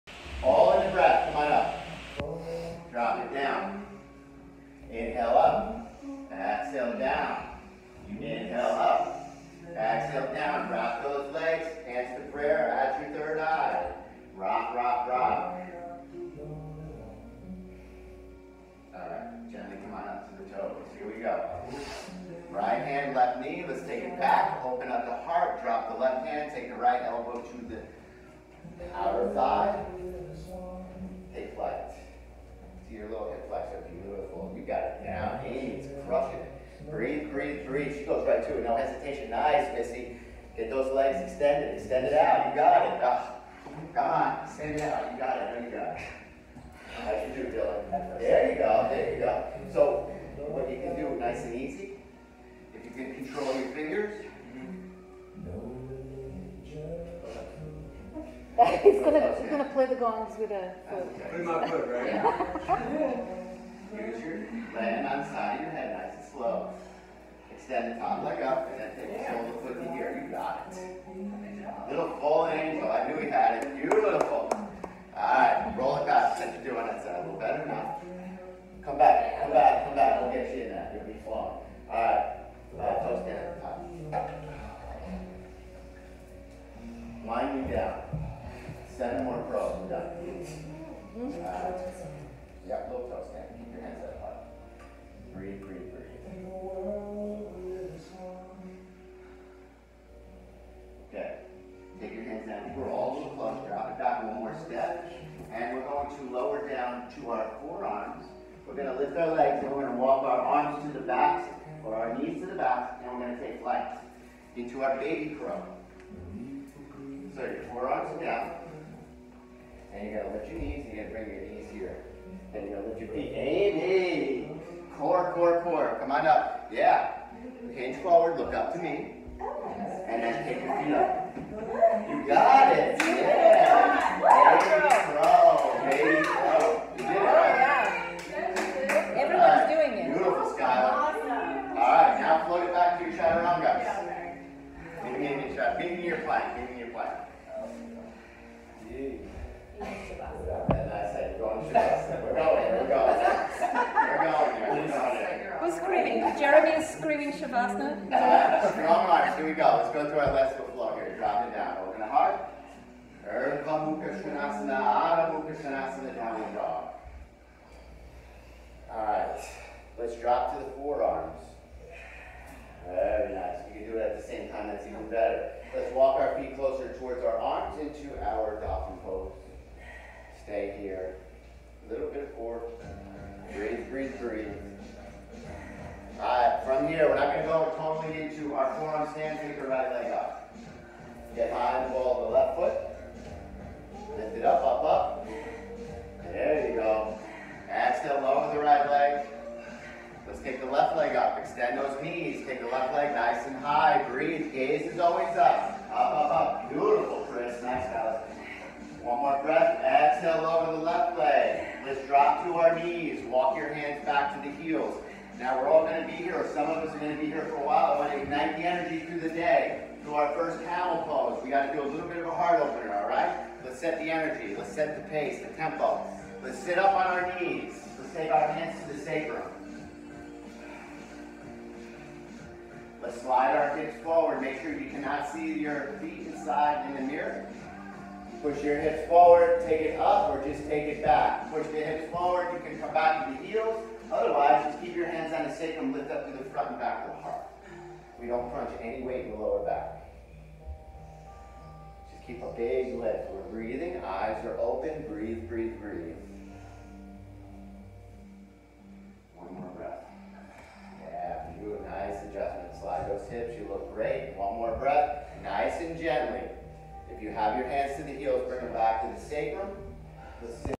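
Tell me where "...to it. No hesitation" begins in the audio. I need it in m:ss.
0:38.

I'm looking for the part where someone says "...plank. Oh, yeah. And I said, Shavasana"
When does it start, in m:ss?
2:26.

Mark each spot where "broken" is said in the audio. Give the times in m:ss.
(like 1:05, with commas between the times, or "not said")
not said.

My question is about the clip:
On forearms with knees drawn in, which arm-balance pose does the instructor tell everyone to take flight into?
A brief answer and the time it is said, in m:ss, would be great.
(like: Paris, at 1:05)
baby crow, at 1:54.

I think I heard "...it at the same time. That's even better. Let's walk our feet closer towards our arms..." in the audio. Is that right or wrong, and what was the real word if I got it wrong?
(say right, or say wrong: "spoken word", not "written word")
right.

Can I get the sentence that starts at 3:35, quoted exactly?
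Now we're all going to be here, or some of us are going to be here for a while.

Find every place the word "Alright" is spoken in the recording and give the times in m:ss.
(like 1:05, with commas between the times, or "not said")
1:15, 1:21.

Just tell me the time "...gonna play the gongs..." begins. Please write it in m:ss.
0:59.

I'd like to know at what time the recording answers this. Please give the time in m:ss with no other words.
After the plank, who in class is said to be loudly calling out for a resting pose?
2:36.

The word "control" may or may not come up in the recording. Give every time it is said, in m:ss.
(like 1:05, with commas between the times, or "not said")
0:53.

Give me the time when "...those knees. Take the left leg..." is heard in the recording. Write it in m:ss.
3:21.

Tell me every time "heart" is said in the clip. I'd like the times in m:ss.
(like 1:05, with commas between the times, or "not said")
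2:42, 3:42, 4:07.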